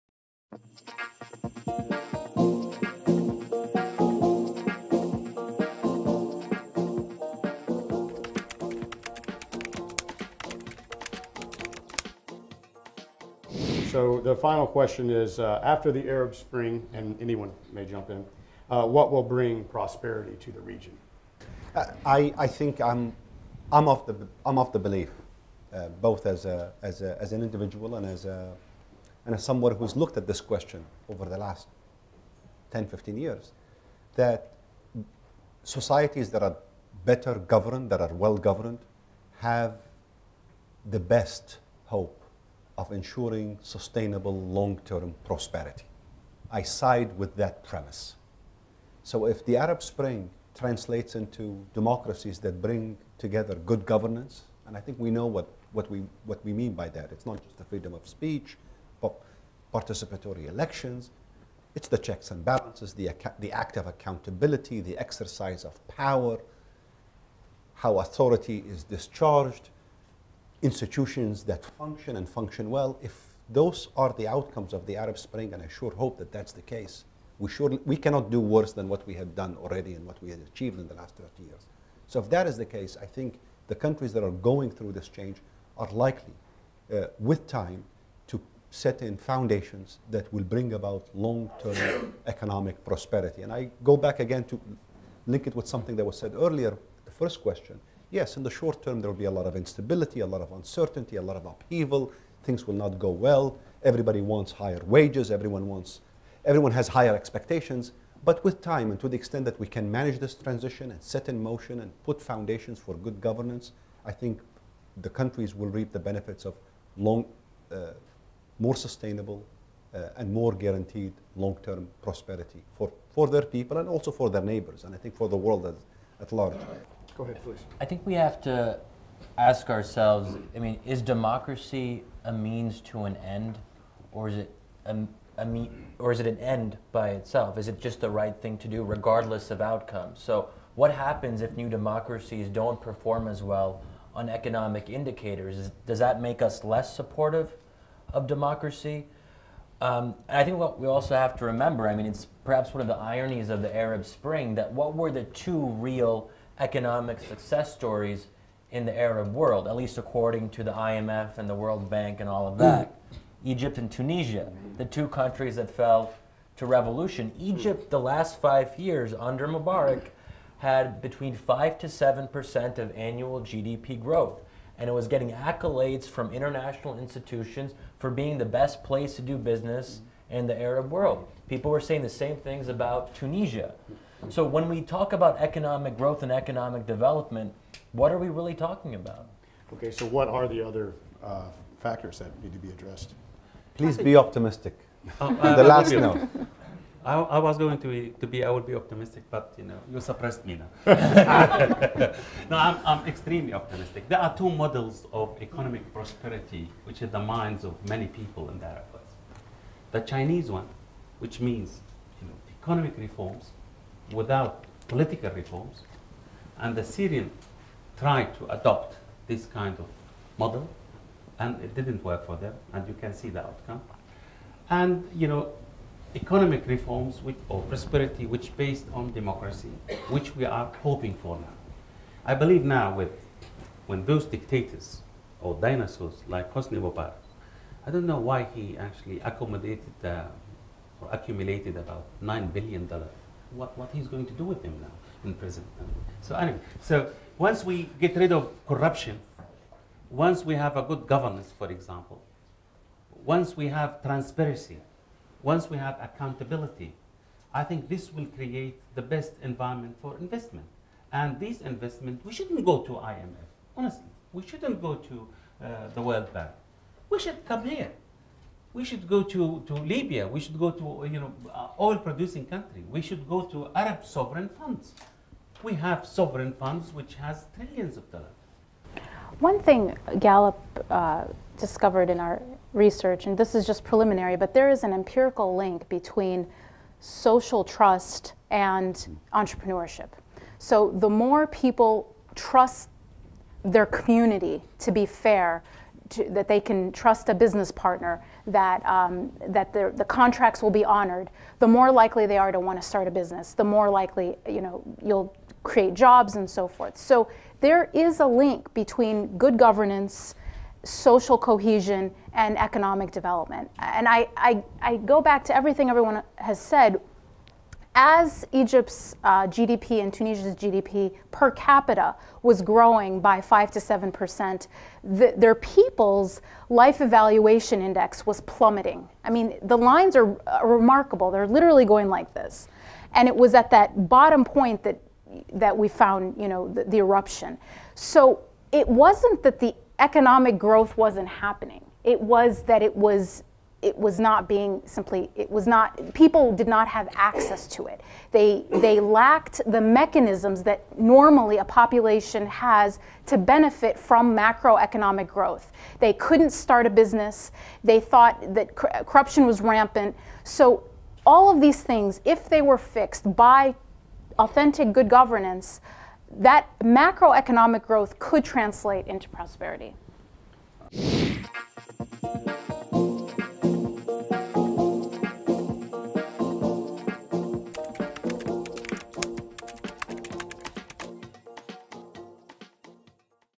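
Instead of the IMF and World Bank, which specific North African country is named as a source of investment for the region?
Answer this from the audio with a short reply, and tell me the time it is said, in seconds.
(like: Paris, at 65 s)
Libya, at 269 s.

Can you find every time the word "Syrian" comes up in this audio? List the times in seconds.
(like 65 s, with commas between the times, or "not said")
216 s.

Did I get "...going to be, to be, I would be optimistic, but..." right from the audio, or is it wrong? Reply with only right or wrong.
right.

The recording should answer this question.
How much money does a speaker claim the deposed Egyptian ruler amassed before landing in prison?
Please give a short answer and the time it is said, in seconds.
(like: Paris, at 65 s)
$9 billion, at 242 s.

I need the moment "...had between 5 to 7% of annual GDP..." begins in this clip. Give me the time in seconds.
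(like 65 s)
170 s.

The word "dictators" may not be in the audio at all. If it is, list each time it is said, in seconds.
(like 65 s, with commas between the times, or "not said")
234 s.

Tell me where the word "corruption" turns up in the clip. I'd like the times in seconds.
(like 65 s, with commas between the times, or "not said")
248 s, 358 s.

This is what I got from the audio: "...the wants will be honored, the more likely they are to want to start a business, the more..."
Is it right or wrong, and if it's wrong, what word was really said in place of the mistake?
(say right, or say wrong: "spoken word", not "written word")
wrong: "contracts", not "wants".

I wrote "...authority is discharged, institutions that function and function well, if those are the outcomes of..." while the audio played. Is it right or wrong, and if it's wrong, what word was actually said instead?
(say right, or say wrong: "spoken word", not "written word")
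right.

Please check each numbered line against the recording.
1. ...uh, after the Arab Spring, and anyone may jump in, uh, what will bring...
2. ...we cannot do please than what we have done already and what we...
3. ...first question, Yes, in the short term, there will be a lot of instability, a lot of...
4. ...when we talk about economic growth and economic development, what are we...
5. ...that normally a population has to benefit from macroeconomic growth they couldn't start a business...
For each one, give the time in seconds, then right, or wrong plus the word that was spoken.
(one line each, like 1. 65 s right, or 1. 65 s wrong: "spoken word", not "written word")
1. 15 s right
2. 77 s wrong: "worse", not "please"
3. 97 s right
4. 184 s right
5. 350 s right.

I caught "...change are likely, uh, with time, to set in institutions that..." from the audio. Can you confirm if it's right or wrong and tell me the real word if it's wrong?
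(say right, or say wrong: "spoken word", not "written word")
wrong: "foundations", not "institutions".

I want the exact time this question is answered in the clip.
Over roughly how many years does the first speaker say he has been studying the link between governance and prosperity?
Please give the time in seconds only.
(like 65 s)
32 s.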